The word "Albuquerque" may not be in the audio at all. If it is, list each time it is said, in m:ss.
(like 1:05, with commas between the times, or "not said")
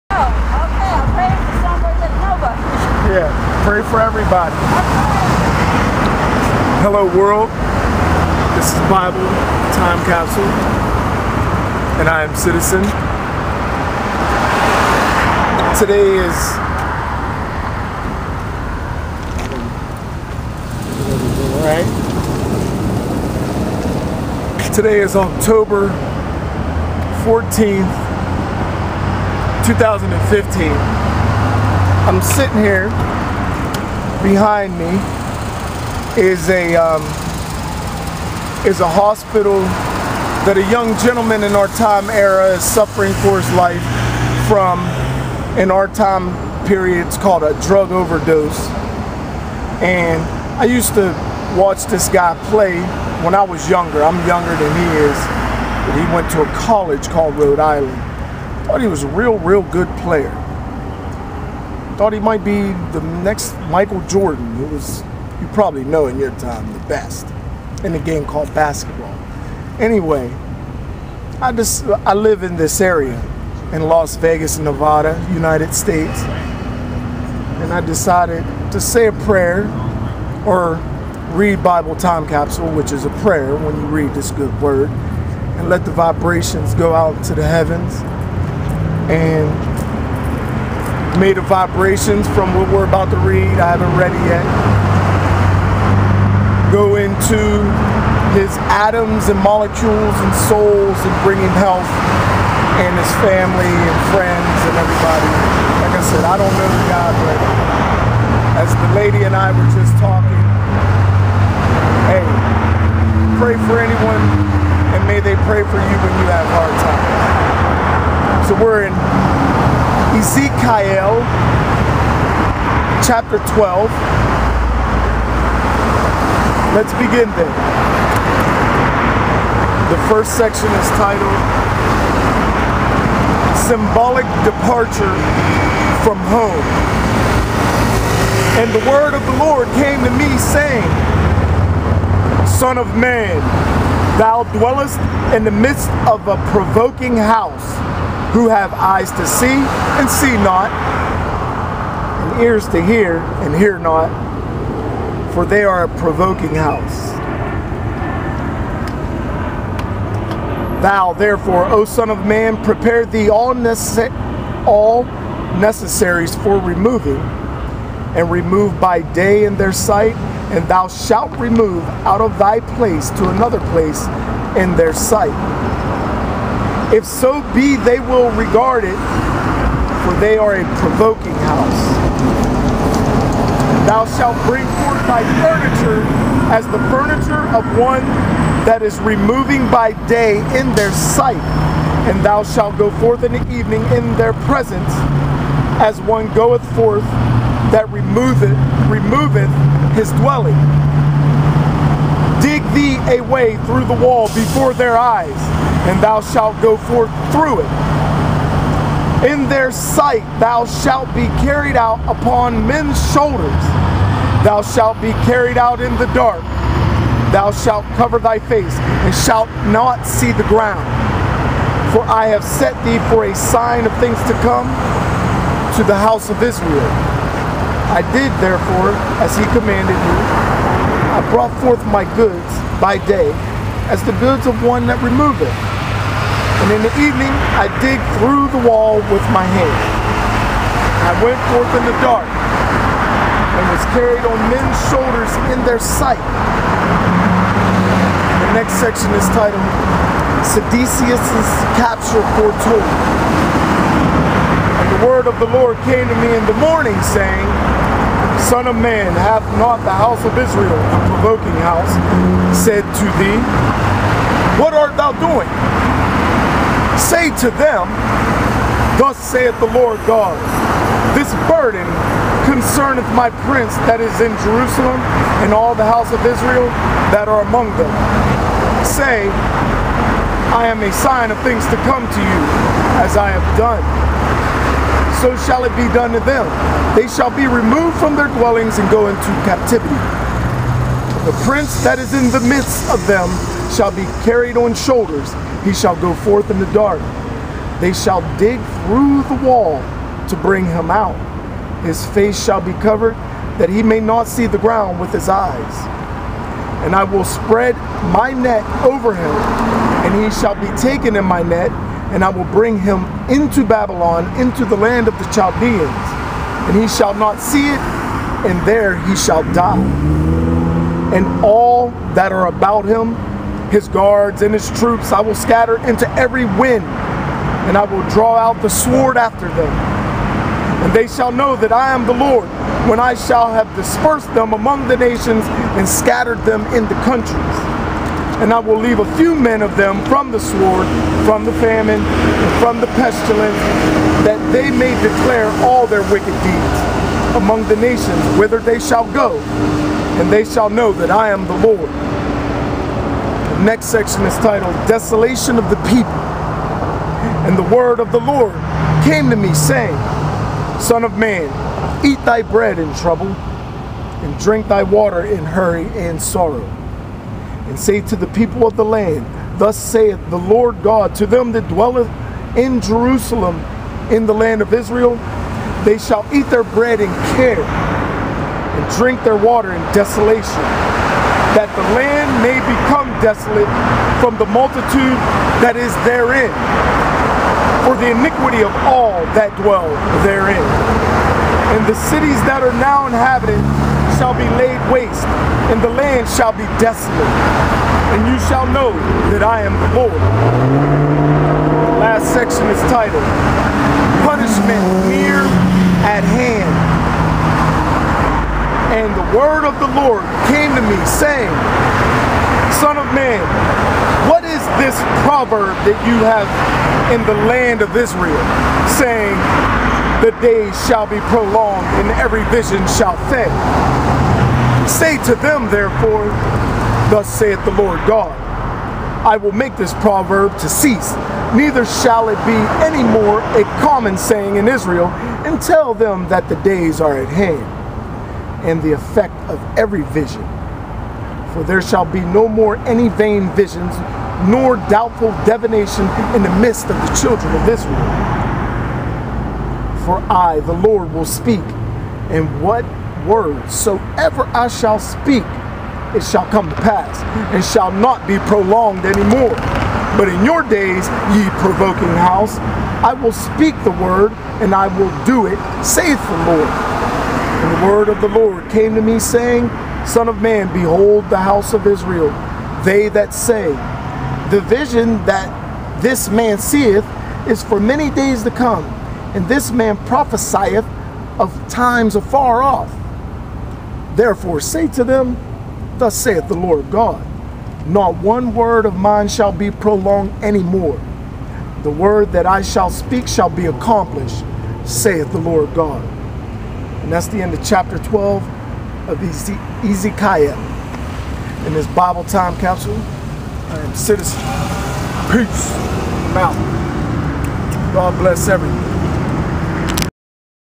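not said.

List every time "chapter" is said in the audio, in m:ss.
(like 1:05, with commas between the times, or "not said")
2:03, 8:17.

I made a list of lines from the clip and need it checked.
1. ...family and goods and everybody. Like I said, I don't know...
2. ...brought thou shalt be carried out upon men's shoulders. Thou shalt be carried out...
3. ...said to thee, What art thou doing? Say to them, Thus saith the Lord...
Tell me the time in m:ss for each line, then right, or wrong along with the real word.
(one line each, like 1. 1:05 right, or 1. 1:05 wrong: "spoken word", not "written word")
1. 1:43 wrong: "friends", not "goods"
2. 3:29 wrong: "sight", not "brought"
3. 4:22 right.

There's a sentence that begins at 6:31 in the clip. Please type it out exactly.
And the cities that are now inhabited shall be laid waste, and the land shall be desolate.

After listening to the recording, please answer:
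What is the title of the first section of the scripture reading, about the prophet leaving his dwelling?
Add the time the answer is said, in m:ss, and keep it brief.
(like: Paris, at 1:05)
Symbolic Departure from Home, at 2:13.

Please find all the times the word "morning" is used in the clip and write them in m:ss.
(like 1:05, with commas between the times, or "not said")
4:16.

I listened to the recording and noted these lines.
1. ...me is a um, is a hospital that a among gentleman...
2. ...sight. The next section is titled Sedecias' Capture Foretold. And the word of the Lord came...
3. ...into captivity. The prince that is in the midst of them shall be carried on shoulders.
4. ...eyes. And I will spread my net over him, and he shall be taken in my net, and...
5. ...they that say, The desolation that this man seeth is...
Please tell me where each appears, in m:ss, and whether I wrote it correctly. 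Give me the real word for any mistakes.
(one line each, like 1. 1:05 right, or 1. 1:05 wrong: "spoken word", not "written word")
1. 0:34 wrong: "young", not "among"
2. 4:05 right
3. 4:49 right
4. 5:05 right
5. 7:52 wrong: "vision", not "desolation".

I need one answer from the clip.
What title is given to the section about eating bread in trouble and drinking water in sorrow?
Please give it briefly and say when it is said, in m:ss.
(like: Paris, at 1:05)
Desolation of the People, at 5:54.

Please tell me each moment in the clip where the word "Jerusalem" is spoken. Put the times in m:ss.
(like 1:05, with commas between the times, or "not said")
4:34, 6:12.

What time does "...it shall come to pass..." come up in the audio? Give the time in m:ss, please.
7:36.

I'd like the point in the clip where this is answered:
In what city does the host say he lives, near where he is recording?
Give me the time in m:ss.
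1:13.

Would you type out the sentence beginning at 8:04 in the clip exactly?
Therefore say to them, Thus saith the Lord God, Not one word of mine shall be prolonged any more.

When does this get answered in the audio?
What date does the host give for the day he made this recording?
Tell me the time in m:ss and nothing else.
0:25.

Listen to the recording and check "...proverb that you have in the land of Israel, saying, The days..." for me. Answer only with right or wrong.
right.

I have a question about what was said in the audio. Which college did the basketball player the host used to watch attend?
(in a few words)
Rhode Island.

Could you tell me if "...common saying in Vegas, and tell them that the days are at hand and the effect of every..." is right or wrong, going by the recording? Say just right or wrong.
wrong.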